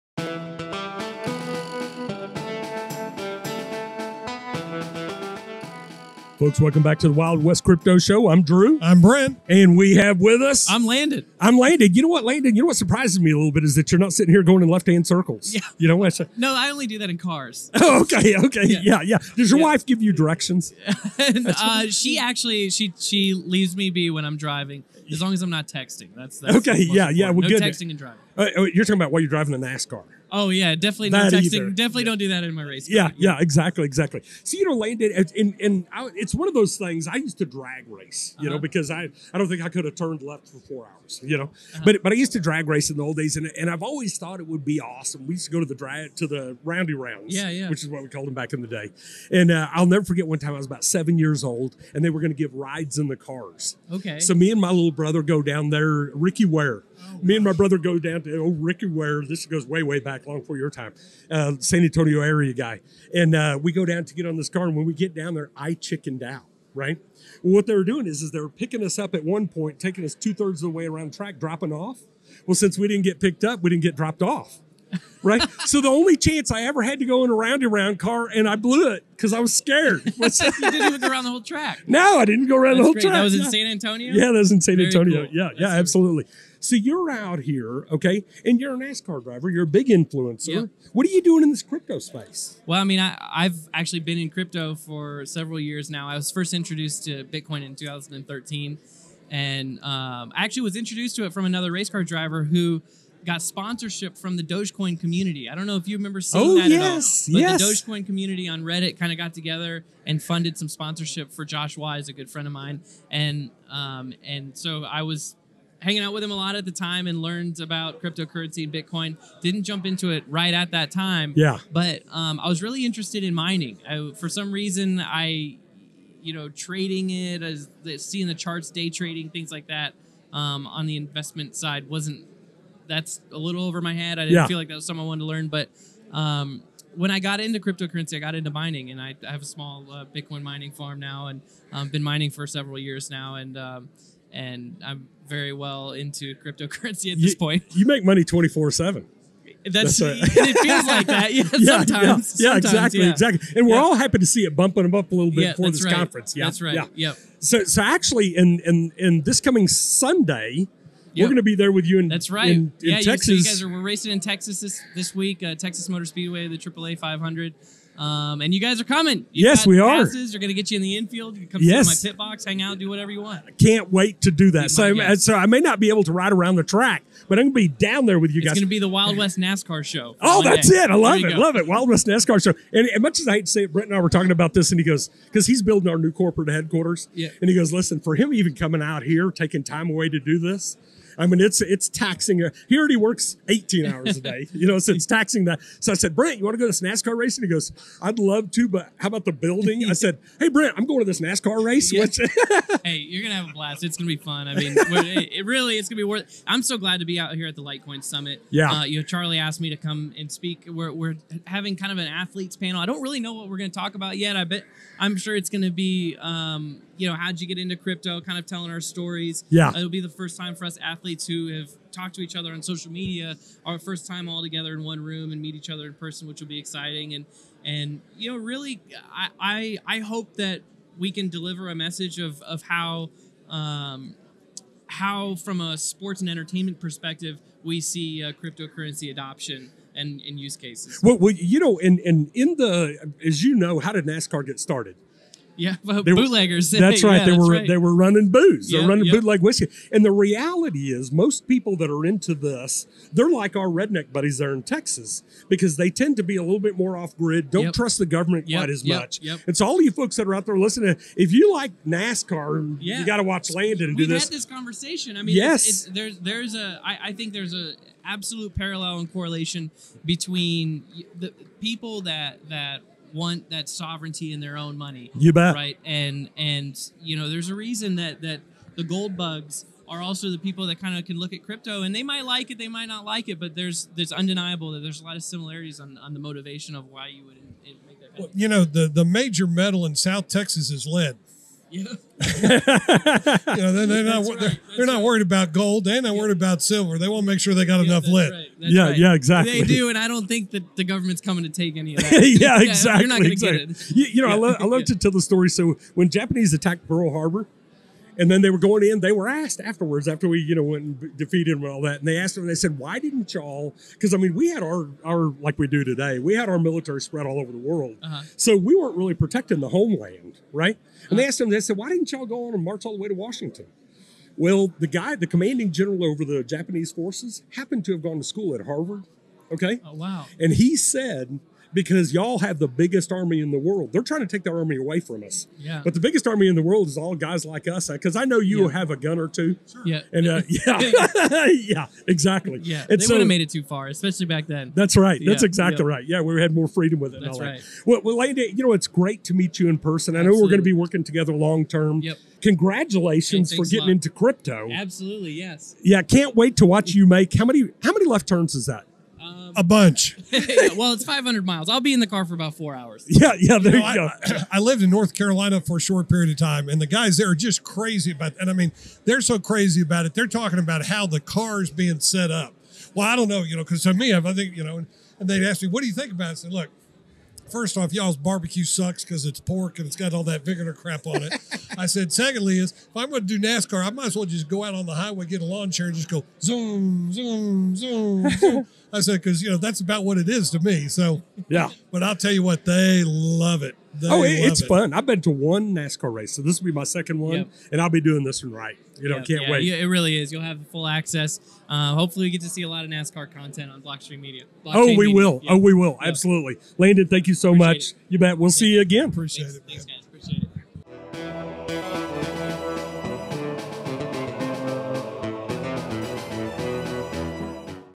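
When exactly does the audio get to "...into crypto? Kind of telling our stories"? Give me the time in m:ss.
3:37.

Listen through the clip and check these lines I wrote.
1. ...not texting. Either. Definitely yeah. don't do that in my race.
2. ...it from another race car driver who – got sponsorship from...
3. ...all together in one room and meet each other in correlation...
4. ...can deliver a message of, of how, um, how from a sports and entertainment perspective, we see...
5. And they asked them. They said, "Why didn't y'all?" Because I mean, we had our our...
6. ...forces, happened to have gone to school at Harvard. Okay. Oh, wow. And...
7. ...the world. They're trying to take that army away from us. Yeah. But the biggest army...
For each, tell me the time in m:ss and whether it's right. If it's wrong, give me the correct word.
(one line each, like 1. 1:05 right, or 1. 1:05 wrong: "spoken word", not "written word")
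1. 0:31 right
2. 1:41 right
3. 3:44 wrong: "person", not "correlation"
4. 3:51 right
5. 5:11 right
6. 5:26 right
7. 5:33 right.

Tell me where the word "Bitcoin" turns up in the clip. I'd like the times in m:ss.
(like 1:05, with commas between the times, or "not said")
1:37, 1:58, 2:20.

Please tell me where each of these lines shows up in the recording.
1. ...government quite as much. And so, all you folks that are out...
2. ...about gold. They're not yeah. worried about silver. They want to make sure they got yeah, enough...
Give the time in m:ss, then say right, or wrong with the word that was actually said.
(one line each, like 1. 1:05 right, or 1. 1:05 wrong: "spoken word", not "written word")
1. 4:18 right
2. 4:55 right.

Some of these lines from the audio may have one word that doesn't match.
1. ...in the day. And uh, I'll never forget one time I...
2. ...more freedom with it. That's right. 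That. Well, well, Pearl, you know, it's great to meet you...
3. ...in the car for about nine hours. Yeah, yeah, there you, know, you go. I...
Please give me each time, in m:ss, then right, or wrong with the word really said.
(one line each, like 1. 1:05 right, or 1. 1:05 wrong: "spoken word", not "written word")
1. 0:48 right
2. 5:46 wrong: "Landy", not "Pearl"
3. 6:01 wrong: "four", not "nine".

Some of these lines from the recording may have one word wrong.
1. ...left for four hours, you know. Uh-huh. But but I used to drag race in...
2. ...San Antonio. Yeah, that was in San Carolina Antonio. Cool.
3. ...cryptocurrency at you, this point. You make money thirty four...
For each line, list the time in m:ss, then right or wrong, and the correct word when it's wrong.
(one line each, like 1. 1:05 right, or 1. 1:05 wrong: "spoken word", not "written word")
1. 0:40 right
2. 1:23 wrong: "Very", not "Carolina"
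3. 2:26 wrong: "twenty", not "thirty".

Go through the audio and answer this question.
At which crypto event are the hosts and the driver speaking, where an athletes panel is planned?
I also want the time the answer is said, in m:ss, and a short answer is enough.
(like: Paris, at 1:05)
Litecoin Summit, at 3:27.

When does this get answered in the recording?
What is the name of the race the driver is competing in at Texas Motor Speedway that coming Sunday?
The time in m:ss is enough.
2:46.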